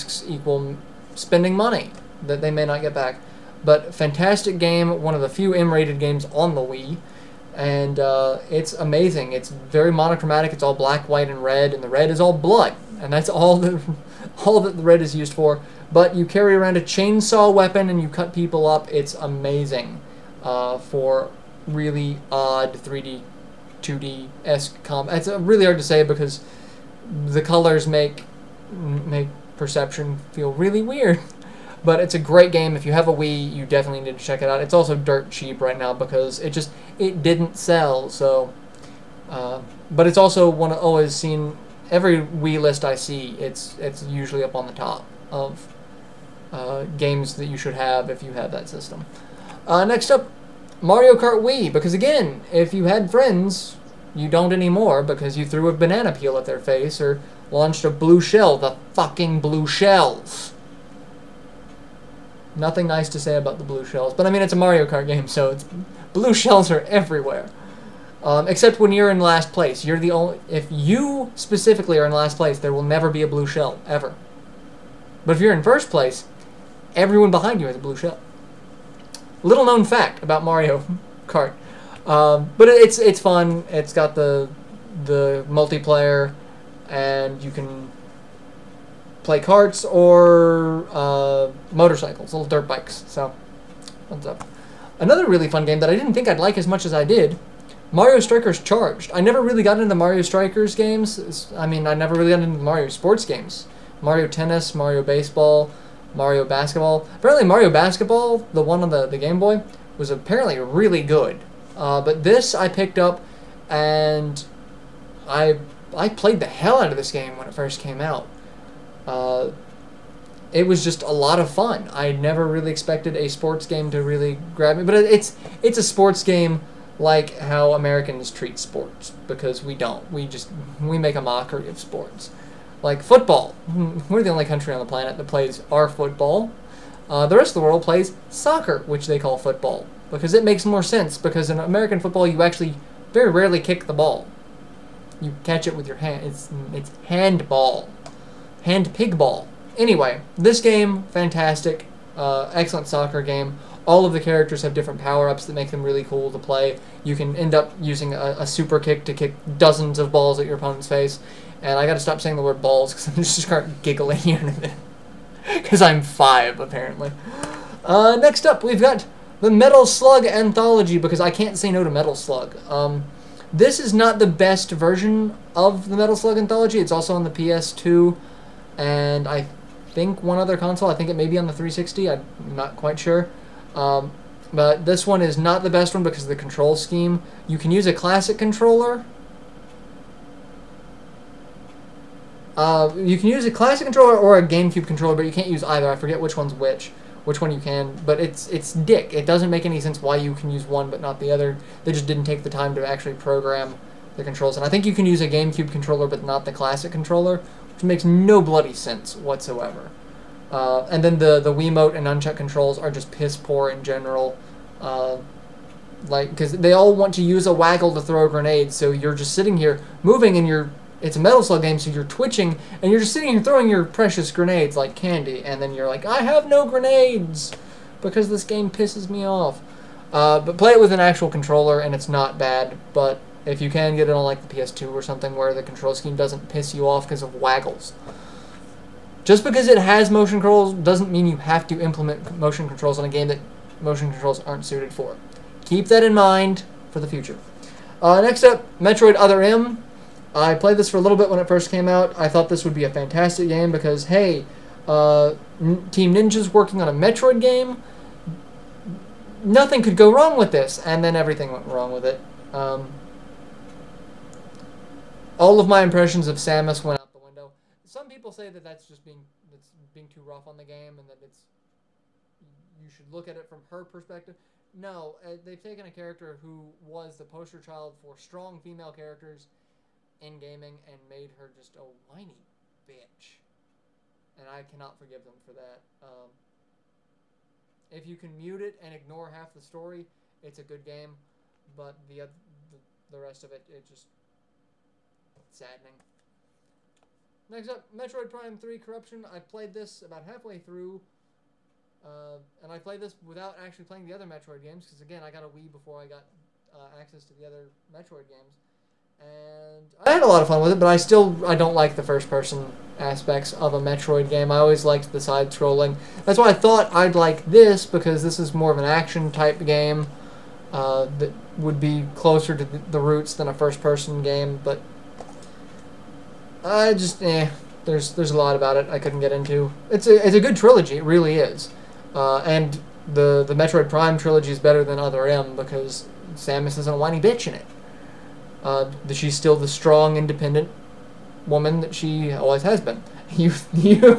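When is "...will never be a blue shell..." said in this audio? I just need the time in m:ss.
1:12.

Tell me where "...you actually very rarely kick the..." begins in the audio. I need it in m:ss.
2:22.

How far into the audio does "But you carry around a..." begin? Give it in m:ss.
0:15.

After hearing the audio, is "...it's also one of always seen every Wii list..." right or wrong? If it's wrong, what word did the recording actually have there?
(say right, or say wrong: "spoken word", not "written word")
right.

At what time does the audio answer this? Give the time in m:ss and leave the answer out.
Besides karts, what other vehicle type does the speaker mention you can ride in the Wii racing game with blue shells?
1:31.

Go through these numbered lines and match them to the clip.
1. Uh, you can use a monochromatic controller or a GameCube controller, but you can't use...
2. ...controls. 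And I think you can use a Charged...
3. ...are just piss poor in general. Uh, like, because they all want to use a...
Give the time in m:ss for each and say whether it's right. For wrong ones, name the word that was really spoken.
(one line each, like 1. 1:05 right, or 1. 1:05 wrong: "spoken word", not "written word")
1. 3:12 wrong: "classic", not "monochromatic"
2. 3:24 wrong: "GameCube", not "Charged"
3. 3:32 right.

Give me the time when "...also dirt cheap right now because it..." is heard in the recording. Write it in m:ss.
0:34.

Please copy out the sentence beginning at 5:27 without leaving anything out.
There's there's a lot about it I couldn't get into.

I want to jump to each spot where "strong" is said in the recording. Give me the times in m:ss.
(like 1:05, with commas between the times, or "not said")
4:38, 5:39.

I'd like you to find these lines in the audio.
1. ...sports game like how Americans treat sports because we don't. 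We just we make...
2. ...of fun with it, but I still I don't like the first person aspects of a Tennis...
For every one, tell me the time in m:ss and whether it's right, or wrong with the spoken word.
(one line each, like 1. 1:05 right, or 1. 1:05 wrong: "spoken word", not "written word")
1. 2:05 right
2. 5:10 wrong: "Metroid", not "Tennis".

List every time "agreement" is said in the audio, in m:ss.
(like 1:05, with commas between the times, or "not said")
not said.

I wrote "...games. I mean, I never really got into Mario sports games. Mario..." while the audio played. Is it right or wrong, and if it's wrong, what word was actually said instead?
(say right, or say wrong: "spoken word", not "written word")
right.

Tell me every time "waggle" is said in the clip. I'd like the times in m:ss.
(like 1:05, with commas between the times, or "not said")
3:37, 3:57.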